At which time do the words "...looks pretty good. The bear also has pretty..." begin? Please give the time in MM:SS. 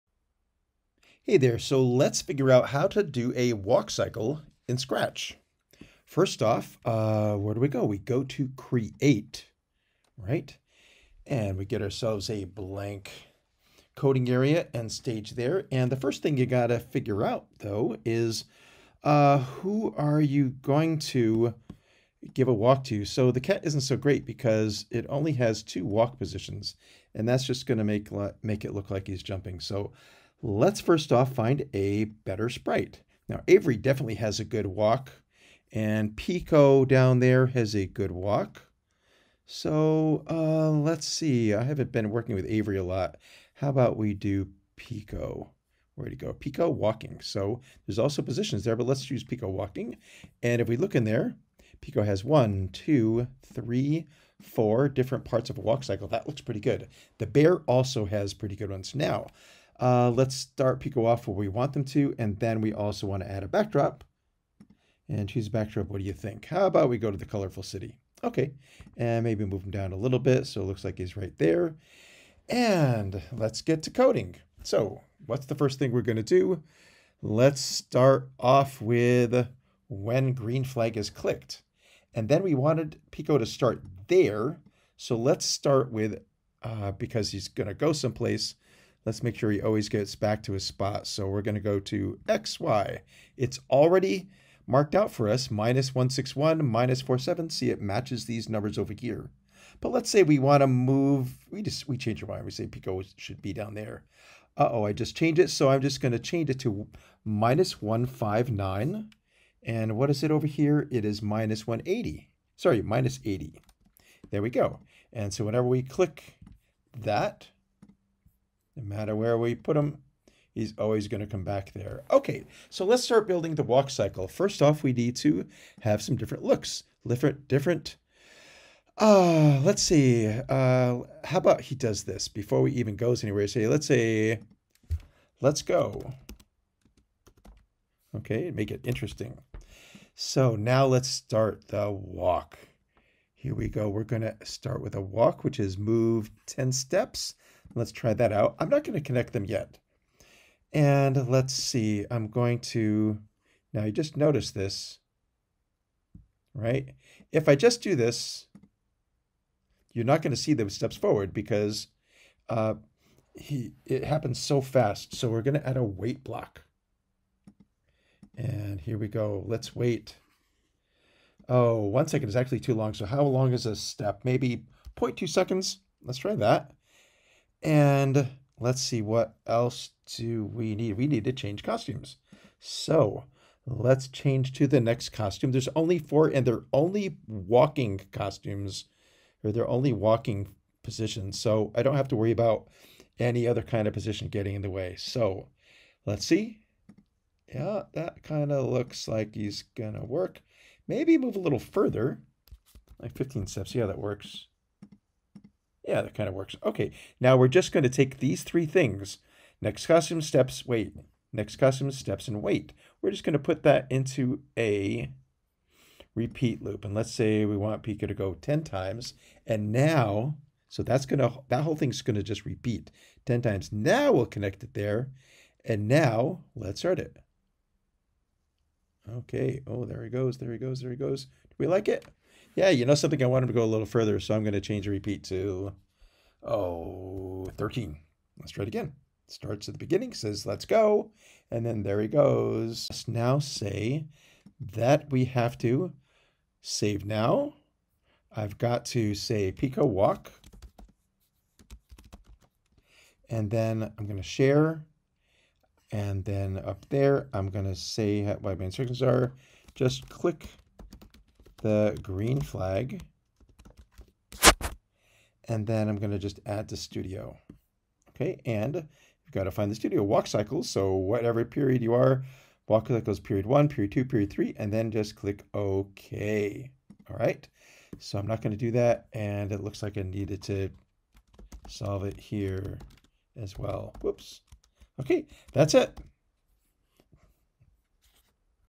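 00:56.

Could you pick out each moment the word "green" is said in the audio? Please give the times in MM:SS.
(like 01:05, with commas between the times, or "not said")
01:20, 04:22.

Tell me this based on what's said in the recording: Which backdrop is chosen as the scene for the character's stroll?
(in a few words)
colorful city.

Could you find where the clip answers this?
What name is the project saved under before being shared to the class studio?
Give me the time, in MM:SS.
04:09.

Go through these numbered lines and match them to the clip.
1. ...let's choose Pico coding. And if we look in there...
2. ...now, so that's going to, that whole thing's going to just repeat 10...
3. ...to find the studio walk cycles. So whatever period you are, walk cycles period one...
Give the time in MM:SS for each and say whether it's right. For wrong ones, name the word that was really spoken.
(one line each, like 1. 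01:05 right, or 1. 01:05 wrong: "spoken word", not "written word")
1. 00:48 wrong: "walking", not "coding"
2. 03:39 right
3. 04:29 right.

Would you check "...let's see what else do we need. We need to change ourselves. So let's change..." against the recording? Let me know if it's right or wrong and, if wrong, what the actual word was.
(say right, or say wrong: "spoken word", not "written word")
wrong: "costumes", not "ourselves".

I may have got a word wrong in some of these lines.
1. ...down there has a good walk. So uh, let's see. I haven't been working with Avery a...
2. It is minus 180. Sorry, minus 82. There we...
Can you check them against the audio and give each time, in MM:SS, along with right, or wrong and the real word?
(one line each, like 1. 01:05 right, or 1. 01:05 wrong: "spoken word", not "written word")
1. 00:36 right
2. 01:50 wrong: "80", not "82".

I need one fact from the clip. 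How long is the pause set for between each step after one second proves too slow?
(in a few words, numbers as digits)
0.2 seconds.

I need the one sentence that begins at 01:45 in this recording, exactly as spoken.
So I'm just going to change it to minus 159.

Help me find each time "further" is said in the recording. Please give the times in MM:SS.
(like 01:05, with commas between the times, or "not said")
03:21, 03:53.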